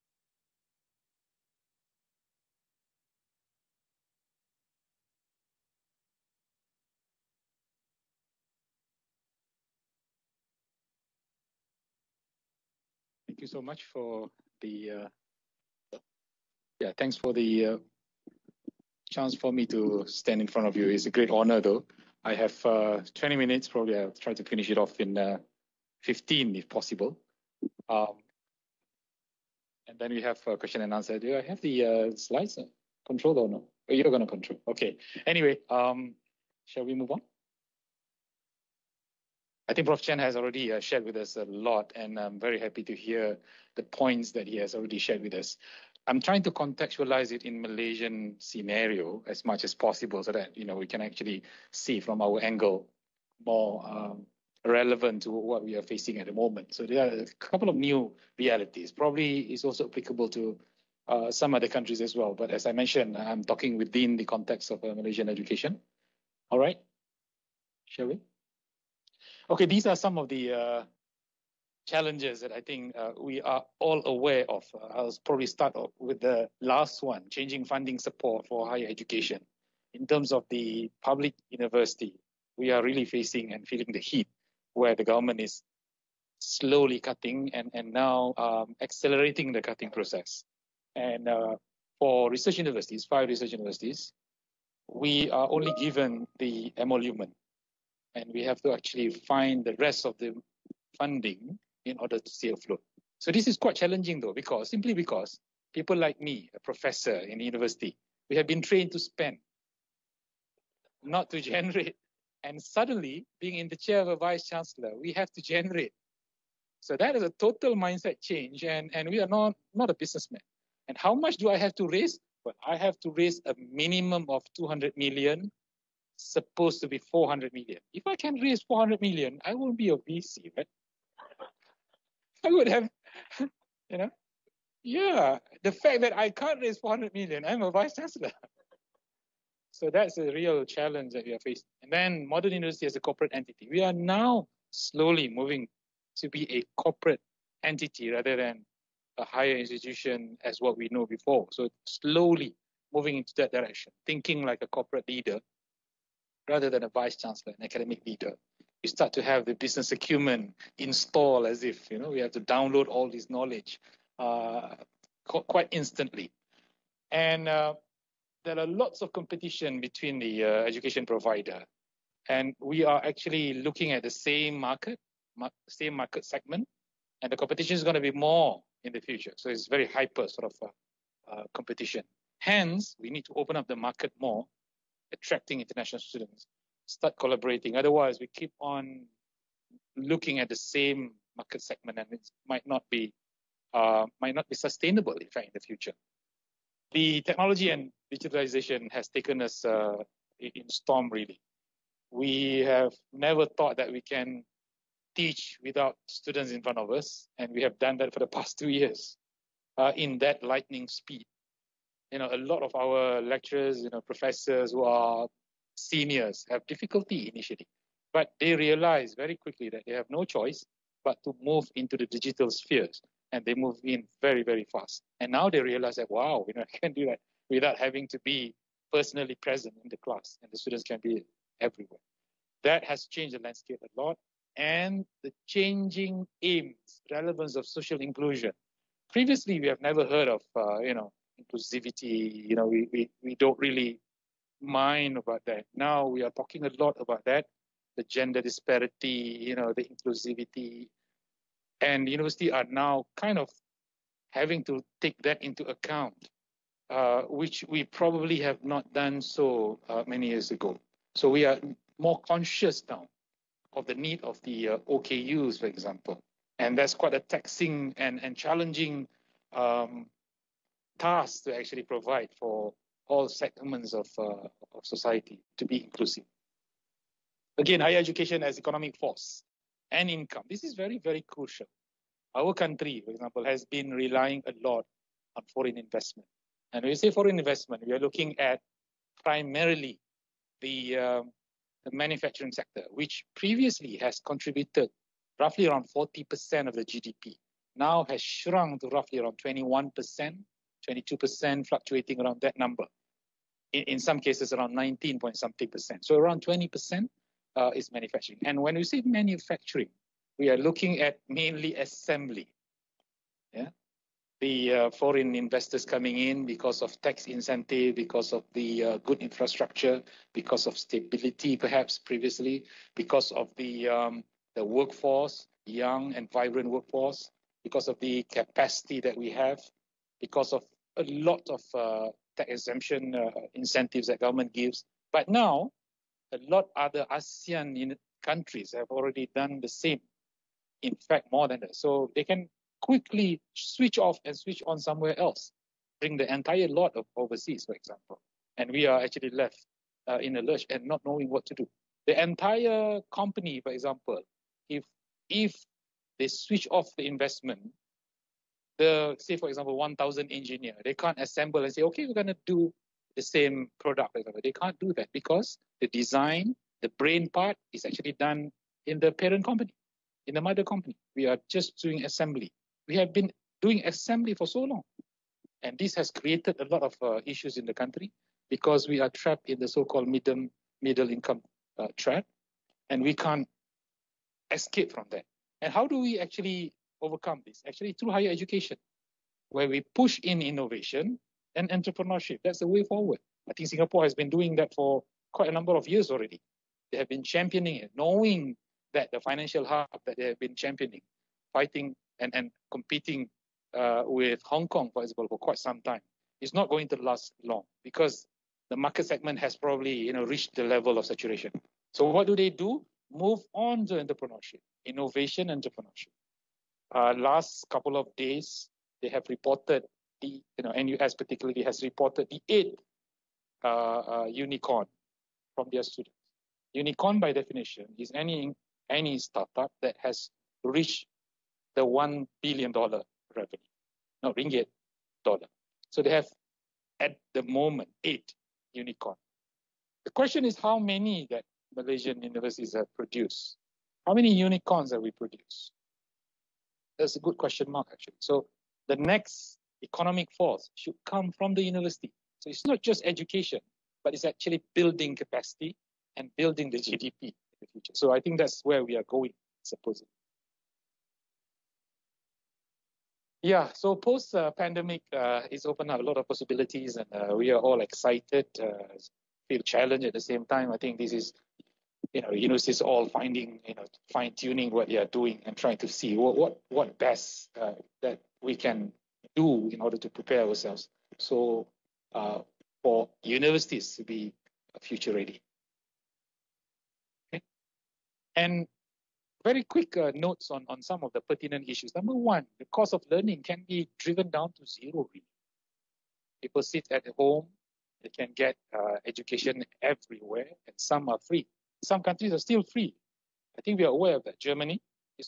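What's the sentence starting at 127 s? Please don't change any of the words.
If I can raise 400 million, I won't be a VC, right?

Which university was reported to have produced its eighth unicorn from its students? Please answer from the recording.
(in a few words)
NUS.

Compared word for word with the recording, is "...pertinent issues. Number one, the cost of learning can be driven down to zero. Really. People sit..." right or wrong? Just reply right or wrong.
right.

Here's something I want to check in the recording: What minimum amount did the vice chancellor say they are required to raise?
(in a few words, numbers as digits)
200 million.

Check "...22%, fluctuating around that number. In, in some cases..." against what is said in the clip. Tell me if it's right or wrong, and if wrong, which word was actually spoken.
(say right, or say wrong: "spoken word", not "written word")
right.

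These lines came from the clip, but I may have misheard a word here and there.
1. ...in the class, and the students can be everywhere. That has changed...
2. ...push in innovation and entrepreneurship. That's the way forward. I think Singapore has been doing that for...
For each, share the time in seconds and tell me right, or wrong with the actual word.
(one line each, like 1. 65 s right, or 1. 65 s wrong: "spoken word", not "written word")
1. 229 s right
2. 389 s right.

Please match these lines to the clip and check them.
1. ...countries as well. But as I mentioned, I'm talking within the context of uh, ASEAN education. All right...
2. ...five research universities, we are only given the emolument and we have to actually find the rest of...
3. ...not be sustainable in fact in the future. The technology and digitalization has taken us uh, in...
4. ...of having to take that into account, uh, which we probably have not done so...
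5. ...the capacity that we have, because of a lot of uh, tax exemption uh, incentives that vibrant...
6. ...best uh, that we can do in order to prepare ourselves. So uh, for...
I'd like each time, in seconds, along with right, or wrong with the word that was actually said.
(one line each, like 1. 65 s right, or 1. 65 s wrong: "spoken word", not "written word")
1. 61 s wrong: "Malaysian", not "ASEAN"
2. 93 s right
3. 194 s right
4. 253 s right
5. 327 s wrong: "government", not "vibrant"
6. 476 s right.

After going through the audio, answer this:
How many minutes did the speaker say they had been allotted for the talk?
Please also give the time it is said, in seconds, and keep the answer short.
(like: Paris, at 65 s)
20, at 23 s.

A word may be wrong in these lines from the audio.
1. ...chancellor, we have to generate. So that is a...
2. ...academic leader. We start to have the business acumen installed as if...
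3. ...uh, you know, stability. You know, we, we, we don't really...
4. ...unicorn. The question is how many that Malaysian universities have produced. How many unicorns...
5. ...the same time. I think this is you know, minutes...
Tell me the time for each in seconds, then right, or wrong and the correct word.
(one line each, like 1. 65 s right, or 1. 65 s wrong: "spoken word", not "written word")
1. 114 s right
2. 157 s right
3. 240 s wrong: "inclusivity", not "stability"
4. 438 s right
5. 470 s wrong: "universities", not "minutes".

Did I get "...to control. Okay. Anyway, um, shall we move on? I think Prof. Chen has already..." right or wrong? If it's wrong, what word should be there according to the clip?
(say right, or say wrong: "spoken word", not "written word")
right.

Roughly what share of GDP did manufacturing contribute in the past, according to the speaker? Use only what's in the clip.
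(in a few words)
40%.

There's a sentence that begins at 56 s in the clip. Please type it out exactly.
So there are a couple of new realities.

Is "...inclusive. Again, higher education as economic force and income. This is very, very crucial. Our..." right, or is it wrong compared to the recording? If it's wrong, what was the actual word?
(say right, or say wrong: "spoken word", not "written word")
right.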